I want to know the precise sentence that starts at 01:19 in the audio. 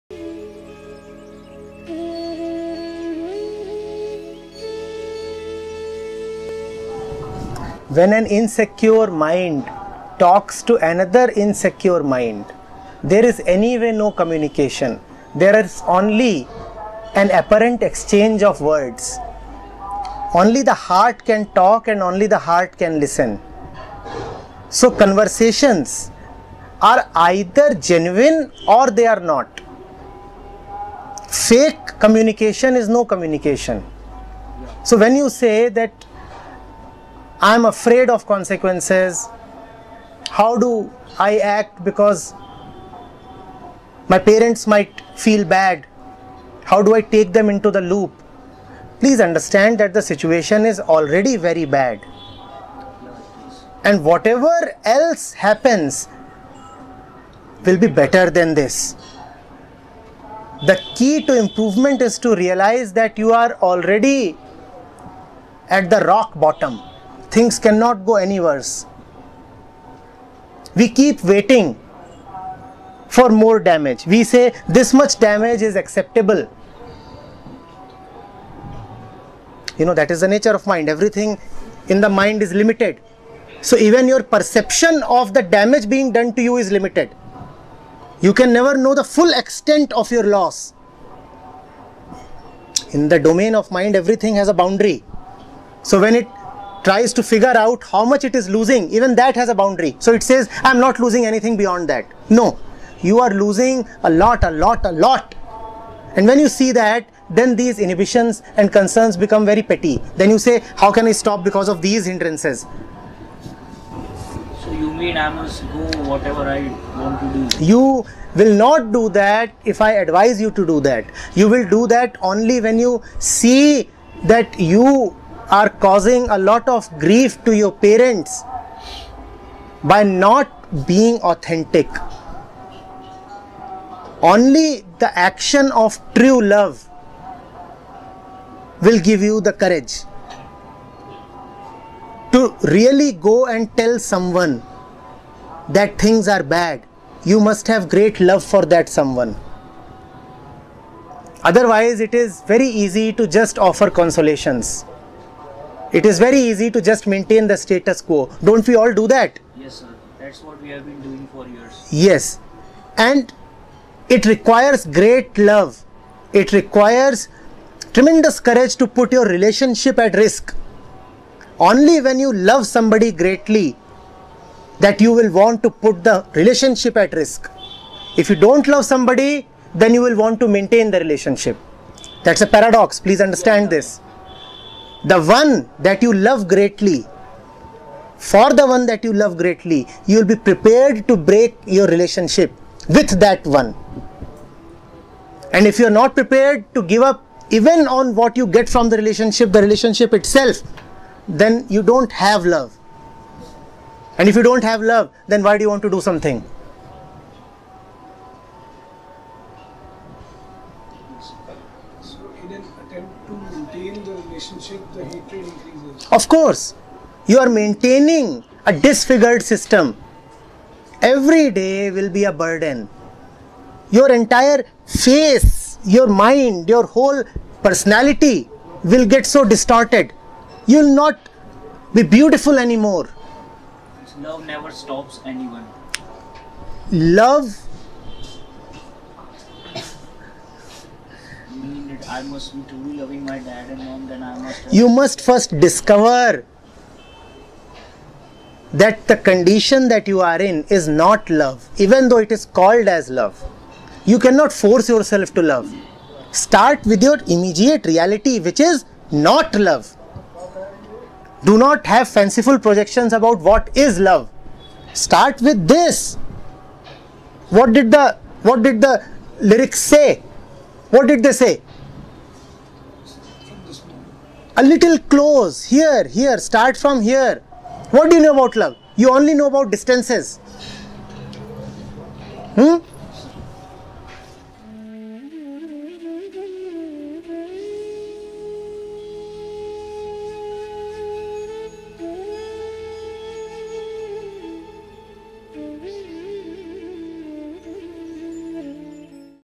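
You know that is the nature of mind.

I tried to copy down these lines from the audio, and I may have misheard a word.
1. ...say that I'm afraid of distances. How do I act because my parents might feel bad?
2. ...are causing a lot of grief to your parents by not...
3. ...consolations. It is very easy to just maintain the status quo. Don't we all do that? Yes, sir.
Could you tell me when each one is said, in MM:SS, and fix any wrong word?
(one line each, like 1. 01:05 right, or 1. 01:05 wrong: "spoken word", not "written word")
1. 00:35 wrong: "consequences", not "distances"
2. 02:05 right
3. 02:33 right.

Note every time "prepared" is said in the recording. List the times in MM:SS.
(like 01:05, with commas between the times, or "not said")
03:10, 03:16.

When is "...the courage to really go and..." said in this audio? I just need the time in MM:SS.
02:19.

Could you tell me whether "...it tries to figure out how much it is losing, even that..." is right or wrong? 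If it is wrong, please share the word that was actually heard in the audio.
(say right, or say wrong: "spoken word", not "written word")
right.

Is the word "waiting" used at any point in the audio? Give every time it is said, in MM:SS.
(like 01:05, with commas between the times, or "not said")
01:11.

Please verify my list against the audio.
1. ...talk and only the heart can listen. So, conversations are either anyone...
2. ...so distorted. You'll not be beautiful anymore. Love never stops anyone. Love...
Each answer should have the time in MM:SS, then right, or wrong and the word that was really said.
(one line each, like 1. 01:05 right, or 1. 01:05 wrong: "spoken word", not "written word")
1. 00:21 wrong: "genuine", not "anyone"
2. 03:49 right.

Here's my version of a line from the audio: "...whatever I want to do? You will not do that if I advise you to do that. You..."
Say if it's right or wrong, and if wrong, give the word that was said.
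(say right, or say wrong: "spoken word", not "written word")
right.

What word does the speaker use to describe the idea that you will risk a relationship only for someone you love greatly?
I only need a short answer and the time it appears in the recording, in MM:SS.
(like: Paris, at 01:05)
Paradox, at 03:02.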